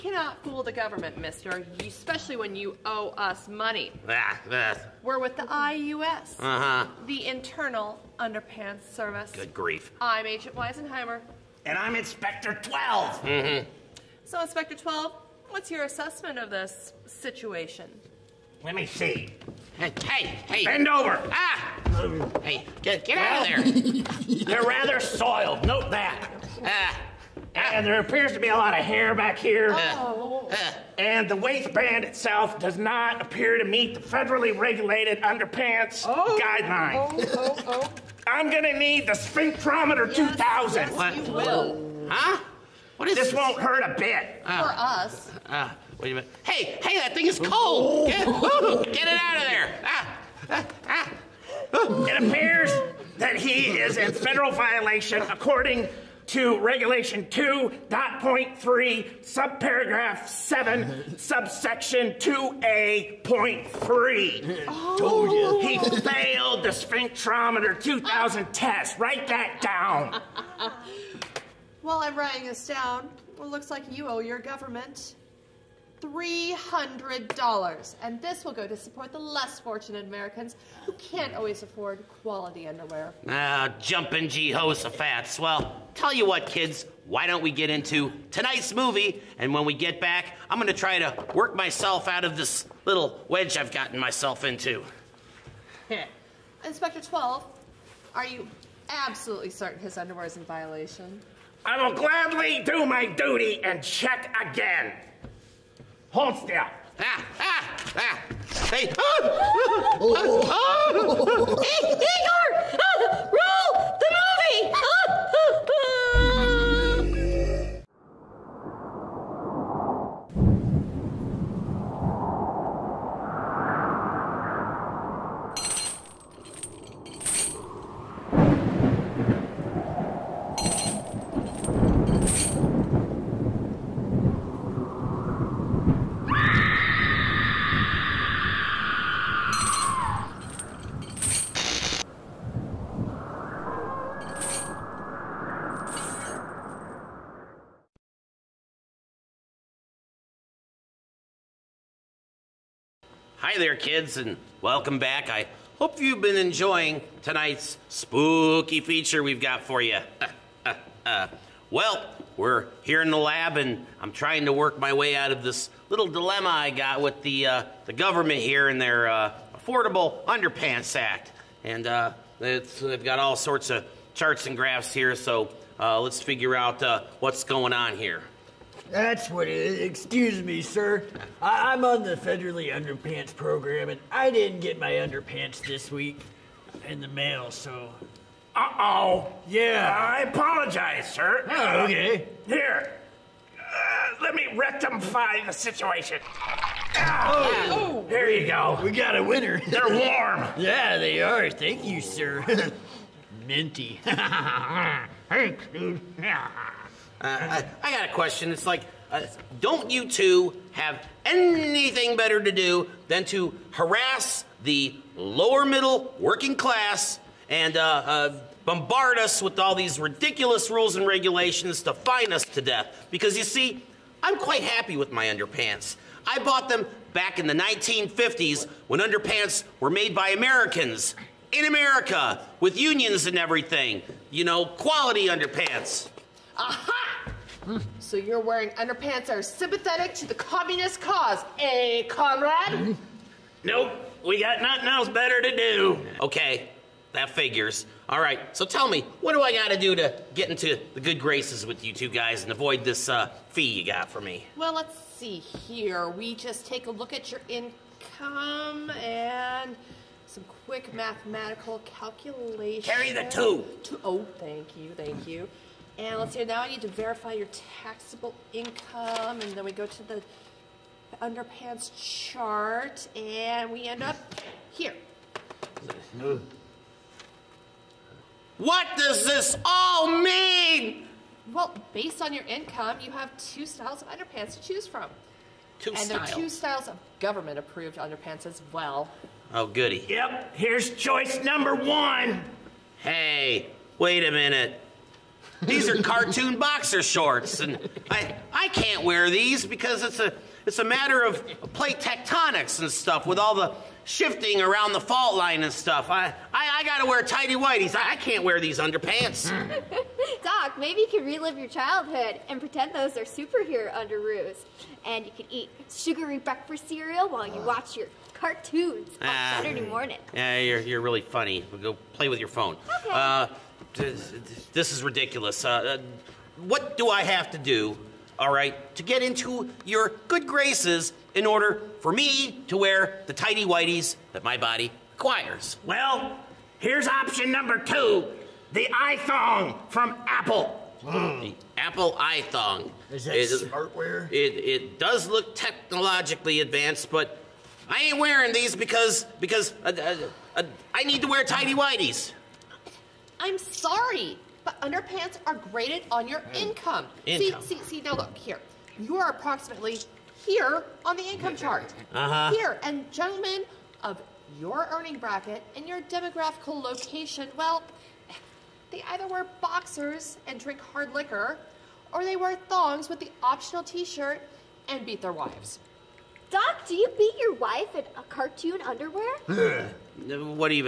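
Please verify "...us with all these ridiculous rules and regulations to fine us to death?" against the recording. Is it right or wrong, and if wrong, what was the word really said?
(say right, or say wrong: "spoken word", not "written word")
right.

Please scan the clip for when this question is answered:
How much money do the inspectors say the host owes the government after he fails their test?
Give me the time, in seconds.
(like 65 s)
76 s.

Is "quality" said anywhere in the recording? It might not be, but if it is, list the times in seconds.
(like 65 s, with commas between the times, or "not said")
82 s, 234 s.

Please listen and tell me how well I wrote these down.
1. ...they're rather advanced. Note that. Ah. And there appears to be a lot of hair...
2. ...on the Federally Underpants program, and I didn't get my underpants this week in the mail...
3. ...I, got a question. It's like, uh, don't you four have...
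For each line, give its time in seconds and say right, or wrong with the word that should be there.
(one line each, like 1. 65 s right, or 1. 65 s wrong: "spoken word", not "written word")
1. 24 s wrong: "soiled", not "advanced"
2. 181 s right
3. 207 s wrong: "two", not "four".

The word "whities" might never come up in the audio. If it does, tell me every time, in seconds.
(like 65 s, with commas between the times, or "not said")
307 s, 333 s, 351 s.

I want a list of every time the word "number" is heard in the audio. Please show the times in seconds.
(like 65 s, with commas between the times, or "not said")
291 s, 337 s.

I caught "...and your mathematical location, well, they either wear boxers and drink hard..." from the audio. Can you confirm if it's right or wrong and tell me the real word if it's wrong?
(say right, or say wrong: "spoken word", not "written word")
wrong: "demographical", not "mathematical".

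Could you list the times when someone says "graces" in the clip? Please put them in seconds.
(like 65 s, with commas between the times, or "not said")
251 s, 330 s.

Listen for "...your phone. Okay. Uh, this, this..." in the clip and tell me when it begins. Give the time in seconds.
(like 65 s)
322 s.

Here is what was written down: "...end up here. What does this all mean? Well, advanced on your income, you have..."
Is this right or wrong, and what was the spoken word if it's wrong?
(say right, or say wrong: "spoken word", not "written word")
wrong: "based", not "advanced".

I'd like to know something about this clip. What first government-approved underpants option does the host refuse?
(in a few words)
Cartoon boxer shorts.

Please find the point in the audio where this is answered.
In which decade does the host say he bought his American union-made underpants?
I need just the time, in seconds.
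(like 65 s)
227 s.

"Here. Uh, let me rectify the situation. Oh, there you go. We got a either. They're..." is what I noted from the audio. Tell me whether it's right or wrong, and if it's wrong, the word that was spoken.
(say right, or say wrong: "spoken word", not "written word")
wrong: "winner", not "either".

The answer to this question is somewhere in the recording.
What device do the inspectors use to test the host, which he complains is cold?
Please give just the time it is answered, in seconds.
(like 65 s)
39 s.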